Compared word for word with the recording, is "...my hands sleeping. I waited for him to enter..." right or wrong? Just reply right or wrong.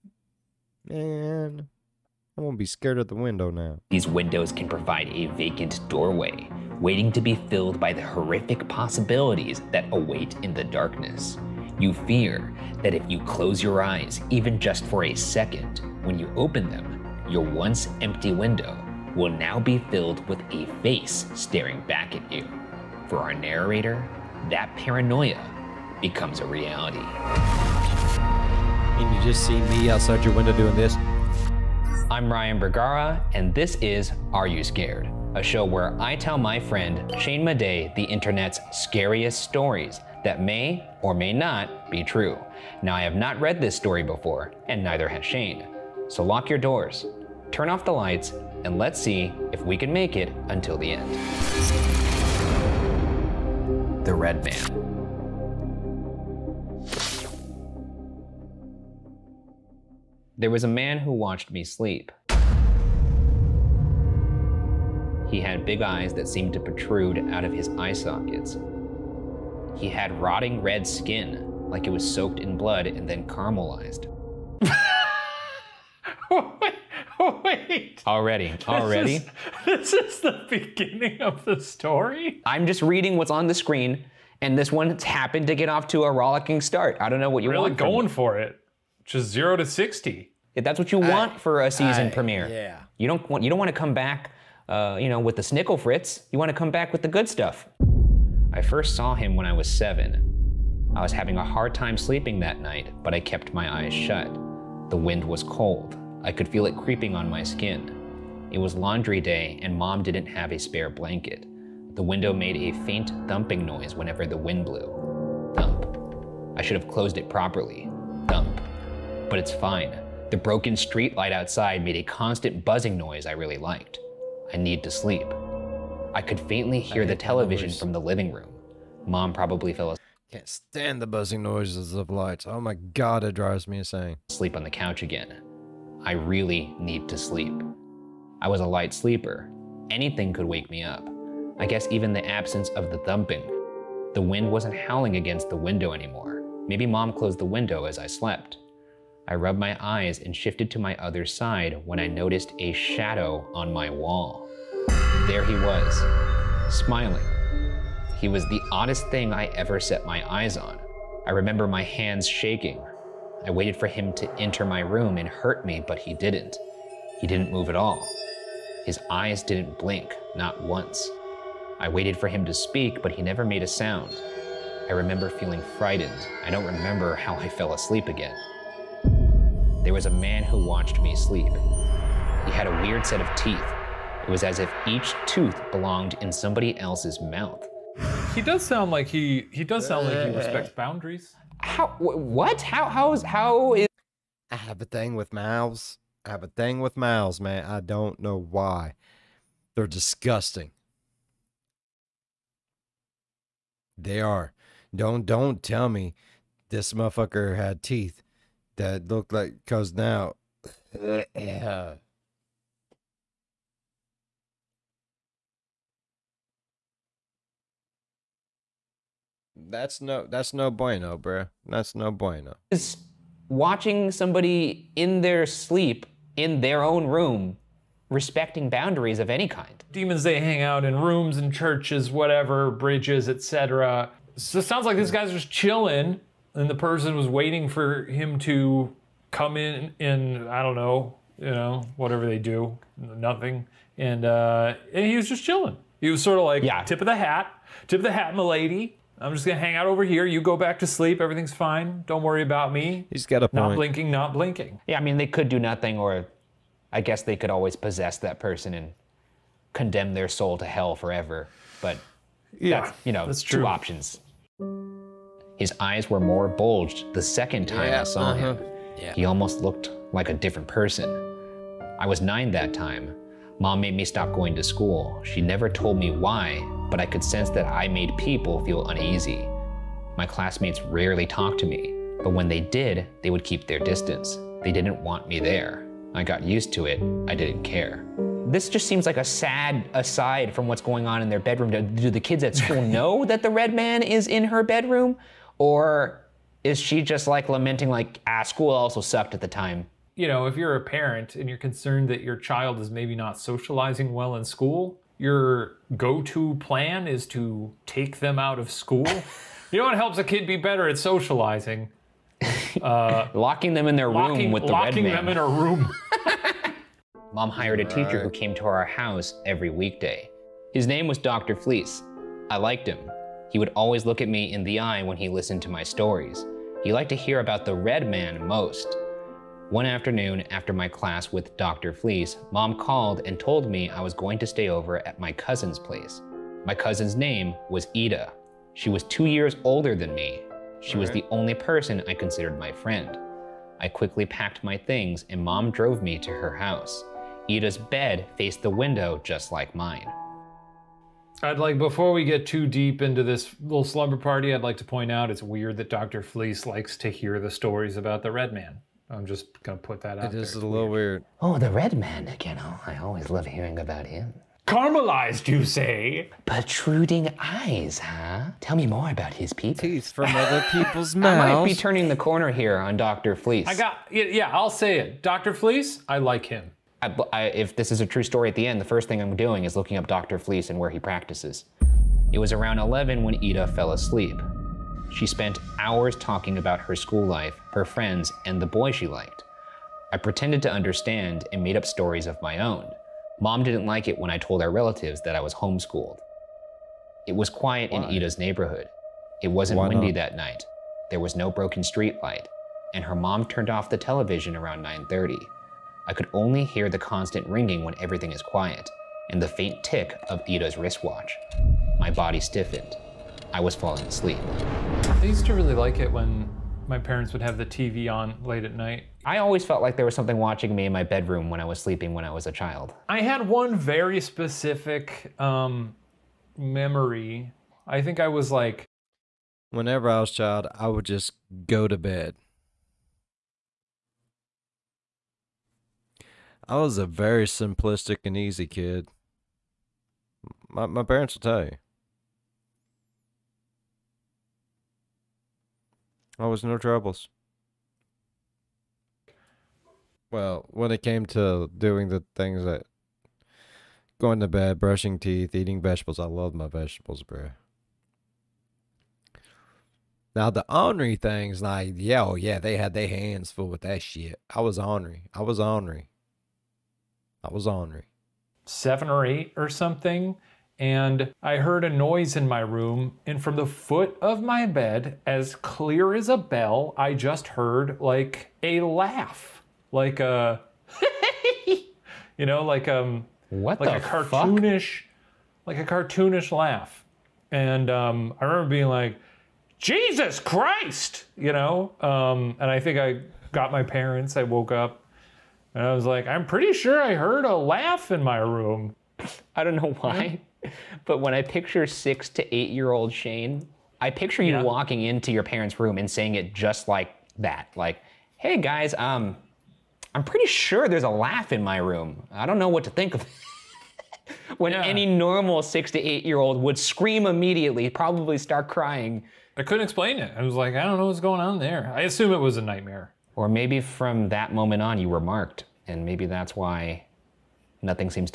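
wrong.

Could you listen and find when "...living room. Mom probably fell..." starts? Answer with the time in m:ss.
2:08.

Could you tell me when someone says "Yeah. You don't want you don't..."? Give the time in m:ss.
1:32.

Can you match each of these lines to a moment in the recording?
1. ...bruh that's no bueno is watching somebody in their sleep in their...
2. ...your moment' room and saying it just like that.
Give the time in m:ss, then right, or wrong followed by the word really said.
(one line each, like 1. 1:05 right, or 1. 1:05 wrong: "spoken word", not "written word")
1. 3:41 right
2. 8:25 wrong: "parents", not "moment".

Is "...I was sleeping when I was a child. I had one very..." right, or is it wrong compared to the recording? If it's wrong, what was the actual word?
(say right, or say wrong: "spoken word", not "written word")
right.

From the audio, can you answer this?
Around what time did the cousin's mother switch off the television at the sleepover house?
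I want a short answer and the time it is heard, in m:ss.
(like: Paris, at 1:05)
9:30, at 6:44.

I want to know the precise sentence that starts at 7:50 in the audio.
And I heard a noise in my room.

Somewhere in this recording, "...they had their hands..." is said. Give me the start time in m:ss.
7:42.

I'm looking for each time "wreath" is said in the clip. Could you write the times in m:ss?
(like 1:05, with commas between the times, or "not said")
not said.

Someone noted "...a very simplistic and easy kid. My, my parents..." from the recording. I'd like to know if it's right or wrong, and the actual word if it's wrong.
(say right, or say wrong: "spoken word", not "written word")
right.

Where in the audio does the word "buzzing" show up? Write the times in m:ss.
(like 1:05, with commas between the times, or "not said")
2:02, 2:11.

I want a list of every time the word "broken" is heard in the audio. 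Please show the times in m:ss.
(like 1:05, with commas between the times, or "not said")
2:00, 6:41.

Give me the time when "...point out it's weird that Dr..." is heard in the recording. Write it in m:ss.
5:54.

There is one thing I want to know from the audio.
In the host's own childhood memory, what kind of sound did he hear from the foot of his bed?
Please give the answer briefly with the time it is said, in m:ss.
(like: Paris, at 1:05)
a cartoonish laugh, at 8:05.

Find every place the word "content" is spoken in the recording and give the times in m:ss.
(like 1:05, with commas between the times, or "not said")
not said.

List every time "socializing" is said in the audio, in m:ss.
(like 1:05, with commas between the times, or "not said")
5:03, 5:10.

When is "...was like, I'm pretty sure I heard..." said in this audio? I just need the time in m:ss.
8:15.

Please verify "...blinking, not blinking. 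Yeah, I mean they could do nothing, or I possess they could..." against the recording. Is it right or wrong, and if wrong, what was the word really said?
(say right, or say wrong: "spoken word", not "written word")
wrong: "guess", not "possess".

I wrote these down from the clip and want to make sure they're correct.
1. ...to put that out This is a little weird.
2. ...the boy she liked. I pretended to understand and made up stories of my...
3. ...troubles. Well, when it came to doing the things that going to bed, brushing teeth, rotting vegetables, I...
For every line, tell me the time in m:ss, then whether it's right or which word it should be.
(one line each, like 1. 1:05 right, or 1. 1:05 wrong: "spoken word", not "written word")
1. 5:59 right
2. 6:28 right
3. 7:26 wrong: "eating", not "rotting".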